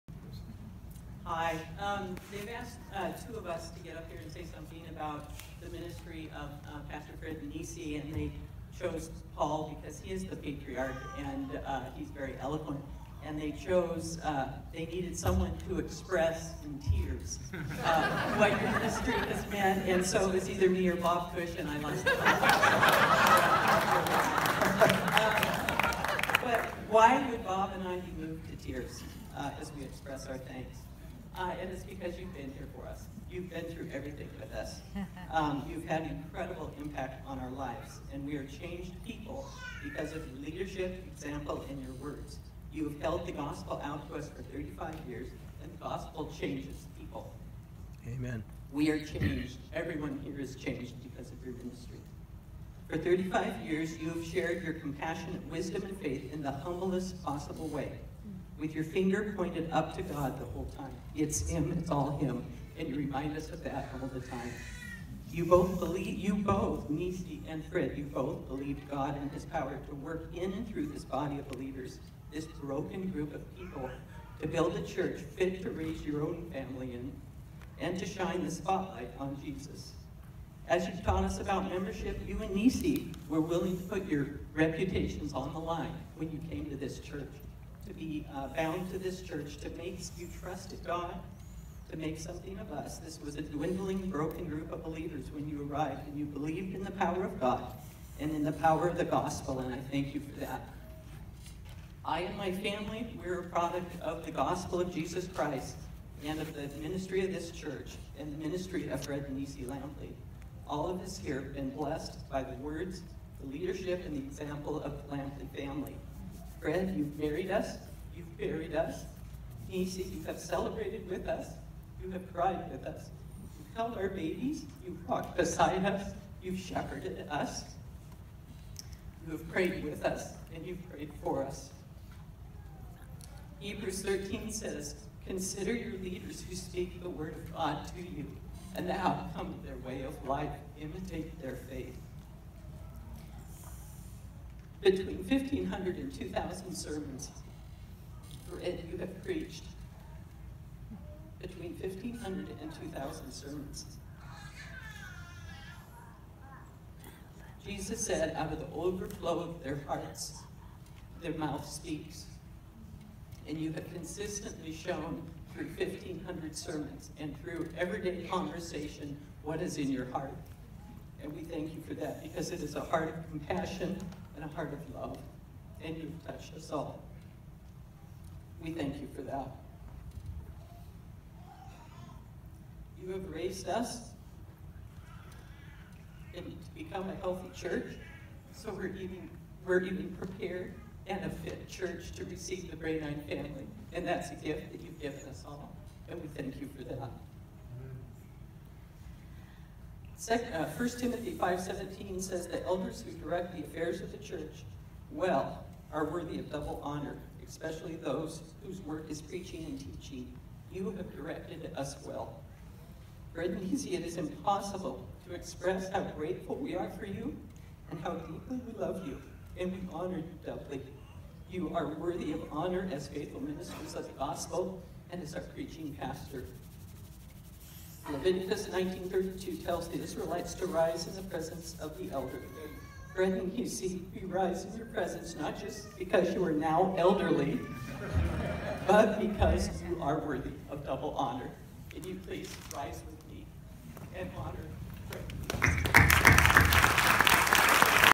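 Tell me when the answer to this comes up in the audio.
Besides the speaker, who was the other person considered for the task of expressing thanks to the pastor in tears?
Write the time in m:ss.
0:20.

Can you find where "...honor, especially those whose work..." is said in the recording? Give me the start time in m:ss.
3:26.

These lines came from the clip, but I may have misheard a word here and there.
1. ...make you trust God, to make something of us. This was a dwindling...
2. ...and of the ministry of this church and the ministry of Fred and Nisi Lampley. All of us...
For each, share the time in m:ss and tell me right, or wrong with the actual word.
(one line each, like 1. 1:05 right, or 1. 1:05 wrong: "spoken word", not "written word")
1. 1:29 right
2. 1:46 right.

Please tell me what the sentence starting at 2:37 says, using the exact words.
Jesus said, out of the overflow of their hearts, their mouth speaks.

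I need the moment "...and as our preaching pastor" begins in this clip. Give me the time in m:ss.
3:45.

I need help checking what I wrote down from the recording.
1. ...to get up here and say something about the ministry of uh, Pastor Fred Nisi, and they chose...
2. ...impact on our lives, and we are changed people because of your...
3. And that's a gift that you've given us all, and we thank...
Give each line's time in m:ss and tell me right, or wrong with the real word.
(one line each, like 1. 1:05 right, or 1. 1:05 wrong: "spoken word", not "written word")
1. 0:03 right
2. 0:36 right
3. 3:13 right.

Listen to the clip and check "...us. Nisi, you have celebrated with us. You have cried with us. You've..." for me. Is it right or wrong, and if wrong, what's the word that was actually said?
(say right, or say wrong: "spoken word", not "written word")
right.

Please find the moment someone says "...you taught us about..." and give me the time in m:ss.
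1:20.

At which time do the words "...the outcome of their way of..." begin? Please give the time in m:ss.
2:18.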